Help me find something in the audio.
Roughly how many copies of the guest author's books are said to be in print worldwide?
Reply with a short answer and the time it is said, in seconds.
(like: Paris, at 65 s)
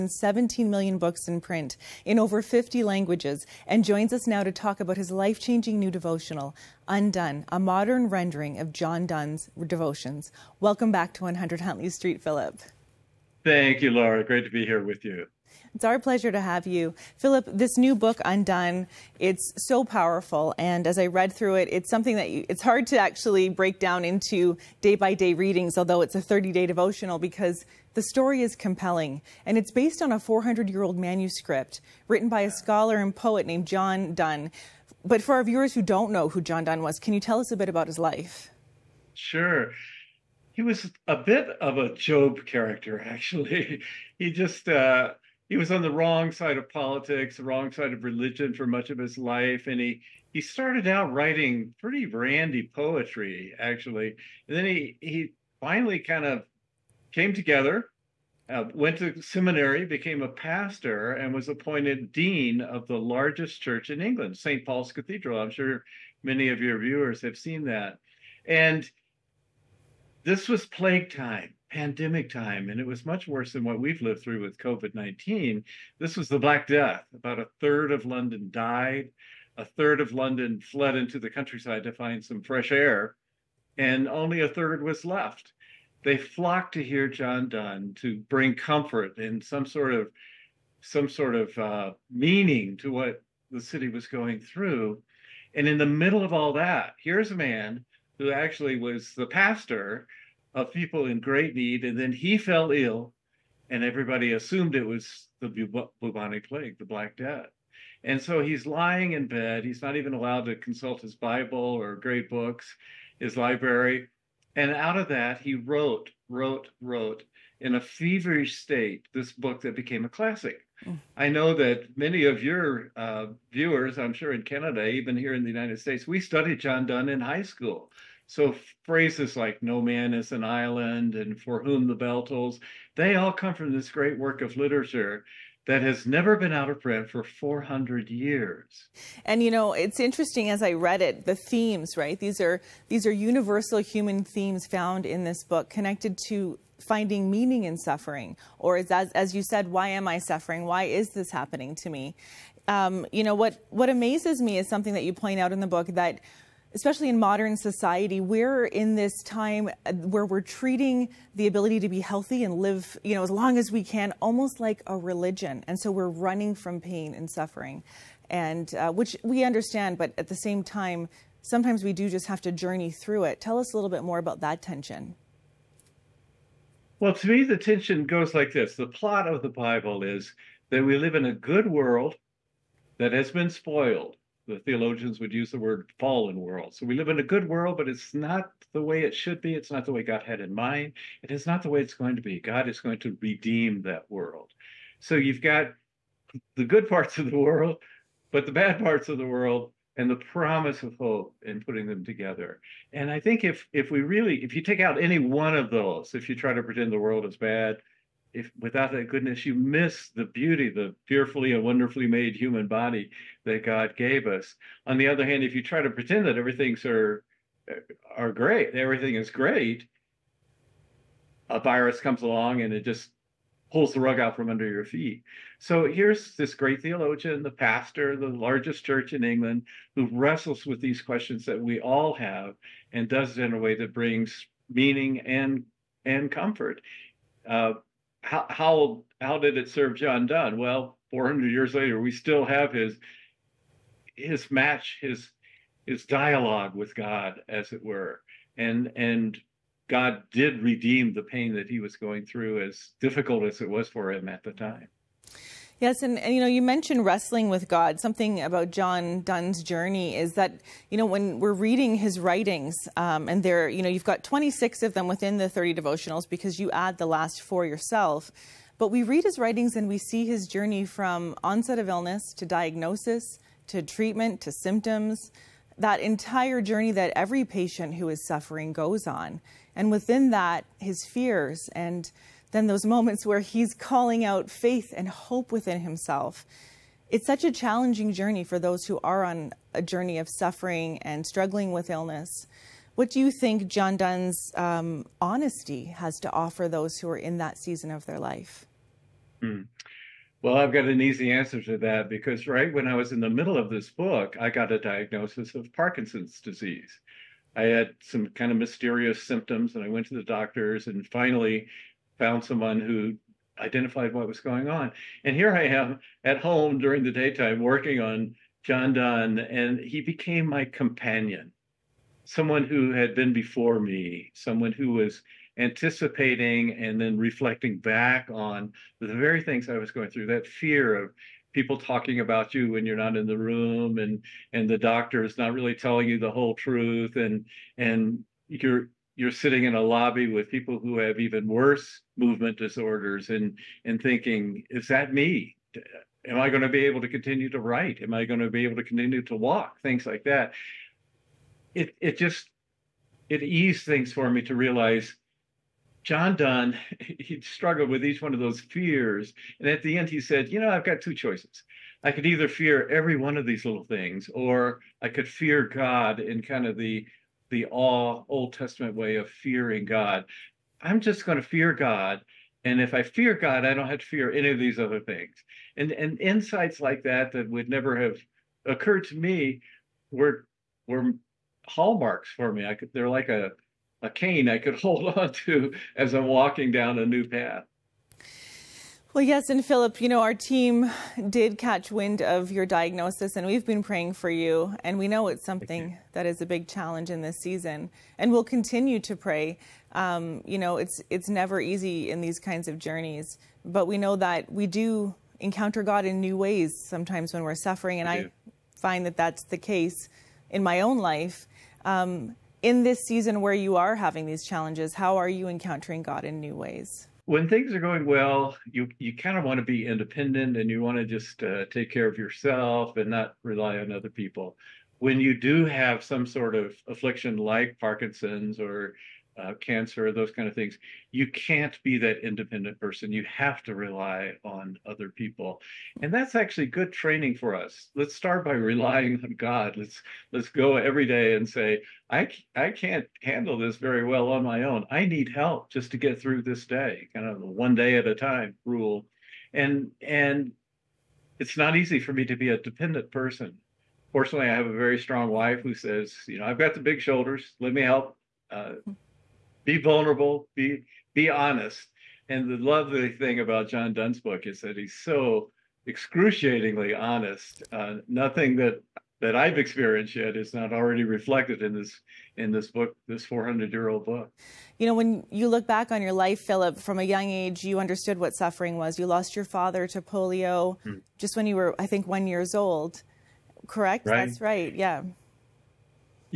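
17 million, at 0 s.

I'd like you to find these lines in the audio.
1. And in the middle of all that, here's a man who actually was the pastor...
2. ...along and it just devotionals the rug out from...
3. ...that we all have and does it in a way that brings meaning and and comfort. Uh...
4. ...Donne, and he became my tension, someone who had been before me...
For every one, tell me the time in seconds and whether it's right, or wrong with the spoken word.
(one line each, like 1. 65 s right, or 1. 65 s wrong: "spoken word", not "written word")
1. 95 s right
2. 222 s wrong: "pulls", not "devotionals"
3. 231 s right
4. 318 s wrong: "companion", not "tension".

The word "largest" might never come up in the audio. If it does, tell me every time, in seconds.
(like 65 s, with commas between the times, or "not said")
62 s, 228 s.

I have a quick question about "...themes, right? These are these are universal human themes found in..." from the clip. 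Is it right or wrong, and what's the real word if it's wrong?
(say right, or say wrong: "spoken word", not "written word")
right.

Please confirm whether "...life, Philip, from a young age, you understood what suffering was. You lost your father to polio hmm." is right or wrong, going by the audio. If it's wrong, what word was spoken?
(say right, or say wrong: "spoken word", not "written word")
right.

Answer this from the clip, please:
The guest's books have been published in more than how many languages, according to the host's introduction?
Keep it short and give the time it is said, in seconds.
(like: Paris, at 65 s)
50, at 2 s.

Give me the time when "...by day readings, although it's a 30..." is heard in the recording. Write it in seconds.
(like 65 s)
24 s.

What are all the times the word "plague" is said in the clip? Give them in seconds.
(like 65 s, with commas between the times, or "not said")
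70 s, 106 s.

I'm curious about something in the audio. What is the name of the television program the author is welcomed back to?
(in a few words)
100 Huntley Street.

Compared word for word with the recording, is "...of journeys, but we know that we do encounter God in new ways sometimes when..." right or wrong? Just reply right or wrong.
right.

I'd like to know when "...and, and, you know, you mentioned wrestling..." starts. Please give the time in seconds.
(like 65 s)
256 s.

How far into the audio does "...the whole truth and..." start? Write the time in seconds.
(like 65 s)
336 s.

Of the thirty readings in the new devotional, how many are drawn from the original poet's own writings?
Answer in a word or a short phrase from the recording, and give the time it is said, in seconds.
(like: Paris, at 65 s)
26, at 264 s.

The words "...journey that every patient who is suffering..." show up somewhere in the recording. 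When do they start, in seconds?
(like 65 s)
276 s.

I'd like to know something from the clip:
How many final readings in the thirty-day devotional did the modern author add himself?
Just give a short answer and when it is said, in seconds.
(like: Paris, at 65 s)
4, at 267 s.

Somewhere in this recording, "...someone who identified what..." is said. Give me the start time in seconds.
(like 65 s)
312 s.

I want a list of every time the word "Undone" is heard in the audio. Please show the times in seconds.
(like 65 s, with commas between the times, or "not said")
6 s, 18 s.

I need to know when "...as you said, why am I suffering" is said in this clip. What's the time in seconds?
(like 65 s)
149 s.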